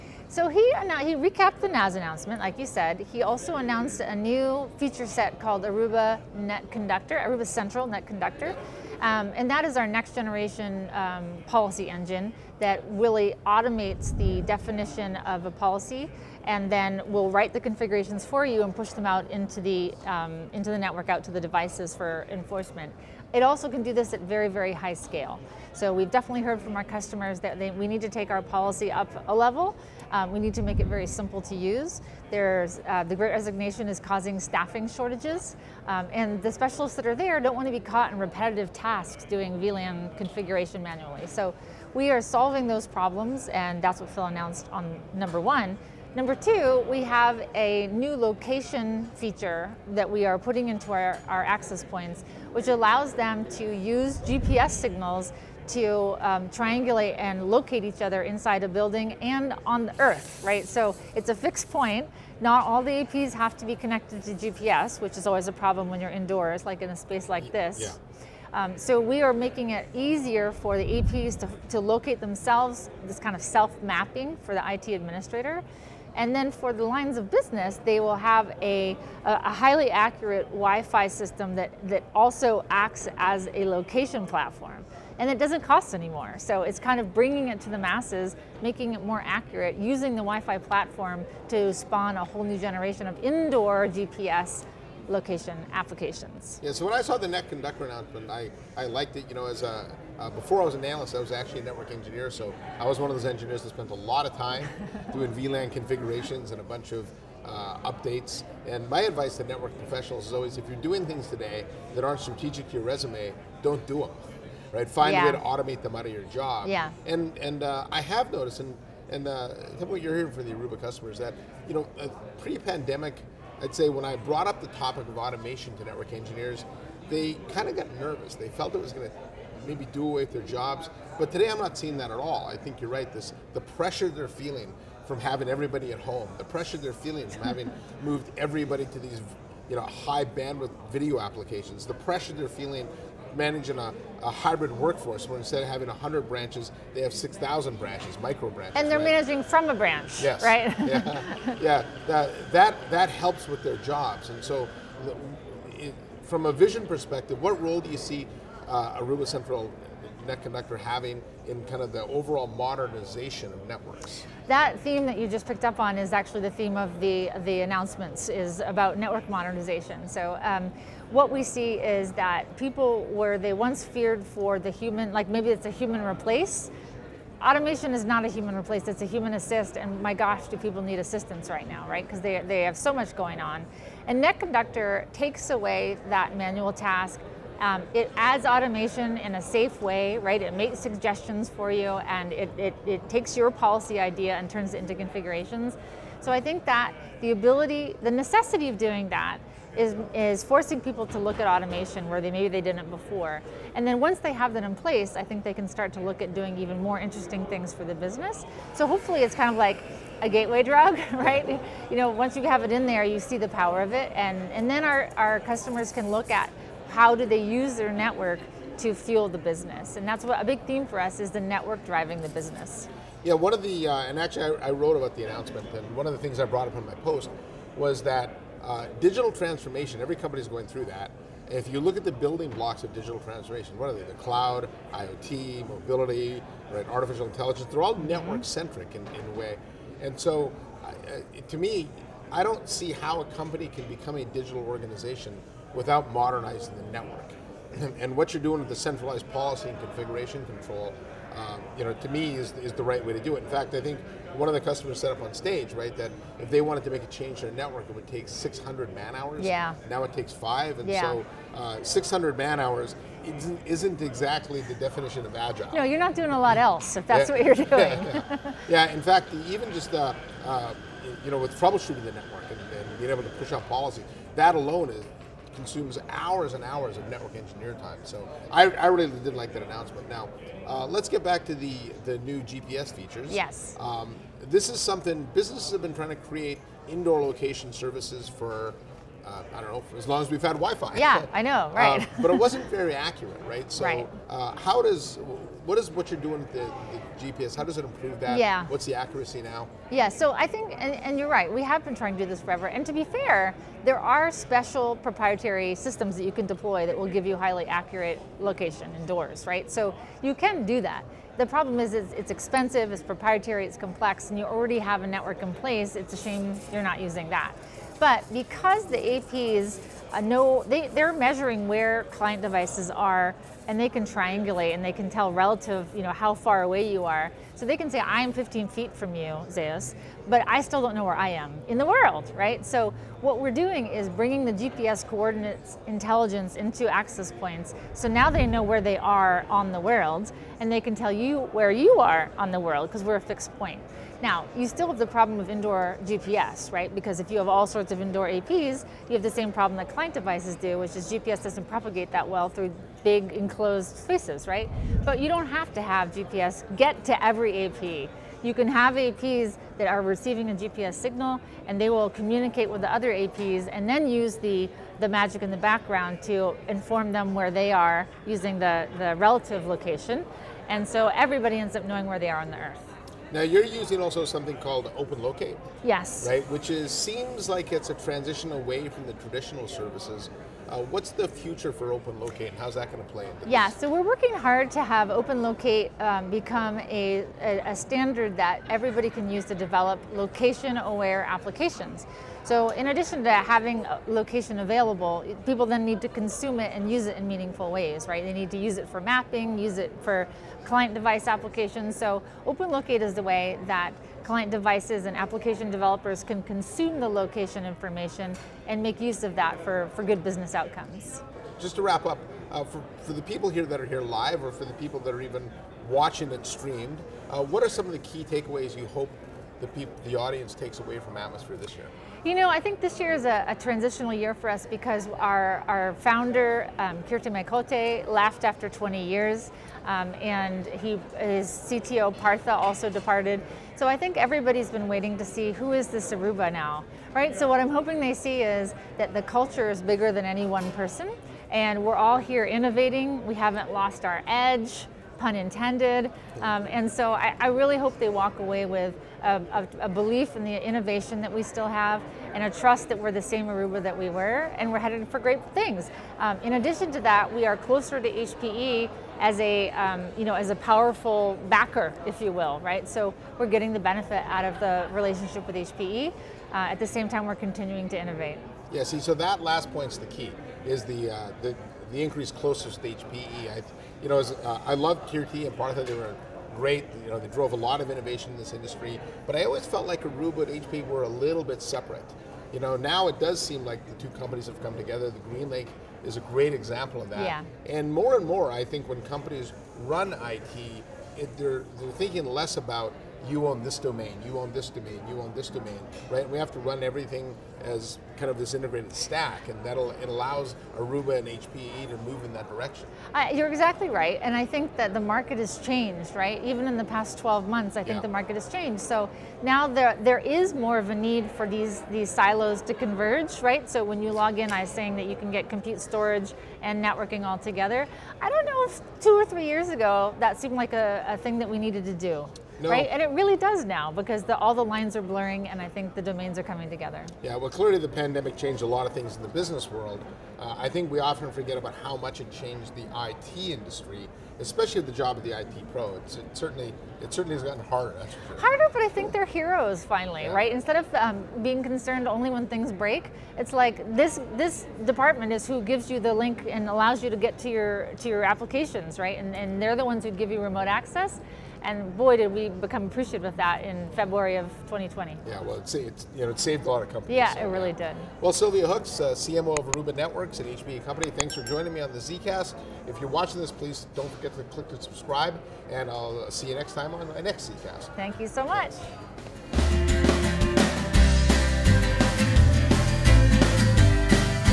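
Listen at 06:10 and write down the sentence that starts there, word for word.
And so everybody ends up knowing where they are on the earth.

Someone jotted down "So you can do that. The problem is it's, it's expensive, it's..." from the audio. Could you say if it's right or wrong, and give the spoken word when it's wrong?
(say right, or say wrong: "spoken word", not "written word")
right.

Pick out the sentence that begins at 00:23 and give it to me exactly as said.
It also can do this at very, very high scale.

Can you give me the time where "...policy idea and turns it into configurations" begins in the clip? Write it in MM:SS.
03:13.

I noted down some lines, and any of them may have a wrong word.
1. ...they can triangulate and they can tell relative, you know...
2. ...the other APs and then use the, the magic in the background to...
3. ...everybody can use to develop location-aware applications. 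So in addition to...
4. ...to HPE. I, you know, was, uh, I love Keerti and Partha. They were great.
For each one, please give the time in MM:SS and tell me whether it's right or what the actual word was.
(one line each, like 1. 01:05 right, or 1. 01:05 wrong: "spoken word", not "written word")
1. 05:23 right
2. 06:02 right
3. 06:28 right
4. 07:52 right.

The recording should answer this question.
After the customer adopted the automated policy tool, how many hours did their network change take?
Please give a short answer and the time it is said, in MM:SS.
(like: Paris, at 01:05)
5, at 04:20.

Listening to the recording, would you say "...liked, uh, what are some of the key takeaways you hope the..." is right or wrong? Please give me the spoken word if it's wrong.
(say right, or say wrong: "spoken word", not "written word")
wrong: "streamed", not "liked".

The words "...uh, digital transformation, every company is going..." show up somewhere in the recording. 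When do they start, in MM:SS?
03:48.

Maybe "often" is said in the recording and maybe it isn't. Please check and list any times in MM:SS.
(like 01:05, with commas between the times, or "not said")
08:50.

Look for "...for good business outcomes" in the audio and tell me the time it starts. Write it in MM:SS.
06:49.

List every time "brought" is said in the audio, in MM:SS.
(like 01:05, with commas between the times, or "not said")
02:04, 03:46.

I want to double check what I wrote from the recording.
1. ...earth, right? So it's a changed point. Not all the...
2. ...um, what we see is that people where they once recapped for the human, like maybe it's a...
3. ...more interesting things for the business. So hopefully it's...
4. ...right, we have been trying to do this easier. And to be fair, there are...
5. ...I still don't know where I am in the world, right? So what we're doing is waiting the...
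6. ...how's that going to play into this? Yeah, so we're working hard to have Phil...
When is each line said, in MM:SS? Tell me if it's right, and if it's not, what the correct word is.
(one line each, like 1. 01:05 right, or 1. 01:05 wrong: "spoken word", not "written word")
1. 01:00 wrong: "fixed", not "changed"
2. 02:50 wrong: "feared", not "recapped"
3. 03:26 right
4. 05:01 wrong: "forever", not "easier"
5. 05:30 wrong: "bringing", not "waiting"
6. 06:22 wrong: "Open", not "Phil".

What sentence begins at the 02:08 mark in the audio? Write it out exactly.
They felt it was going to maybe do away with their jobs.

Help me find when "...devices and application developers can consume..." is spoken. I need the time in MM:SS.
06:44.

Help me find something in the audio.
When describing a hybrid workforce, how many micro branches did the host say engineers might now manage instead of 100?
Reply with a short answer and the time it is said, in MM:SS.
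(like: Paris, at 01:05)
6,000, at 02:27.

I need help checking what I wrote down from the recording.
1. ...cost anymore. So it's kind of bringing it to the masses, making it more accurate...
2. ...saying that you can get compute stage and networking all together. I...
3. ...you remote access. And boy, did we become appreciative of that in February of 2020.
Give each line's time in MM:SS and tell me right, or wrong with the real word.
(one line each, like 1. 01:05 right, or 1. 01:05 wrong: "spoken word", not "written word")
1. 01:25 right
2. 08:34 wrong: "storage", not "stage"
3. 09:10 right.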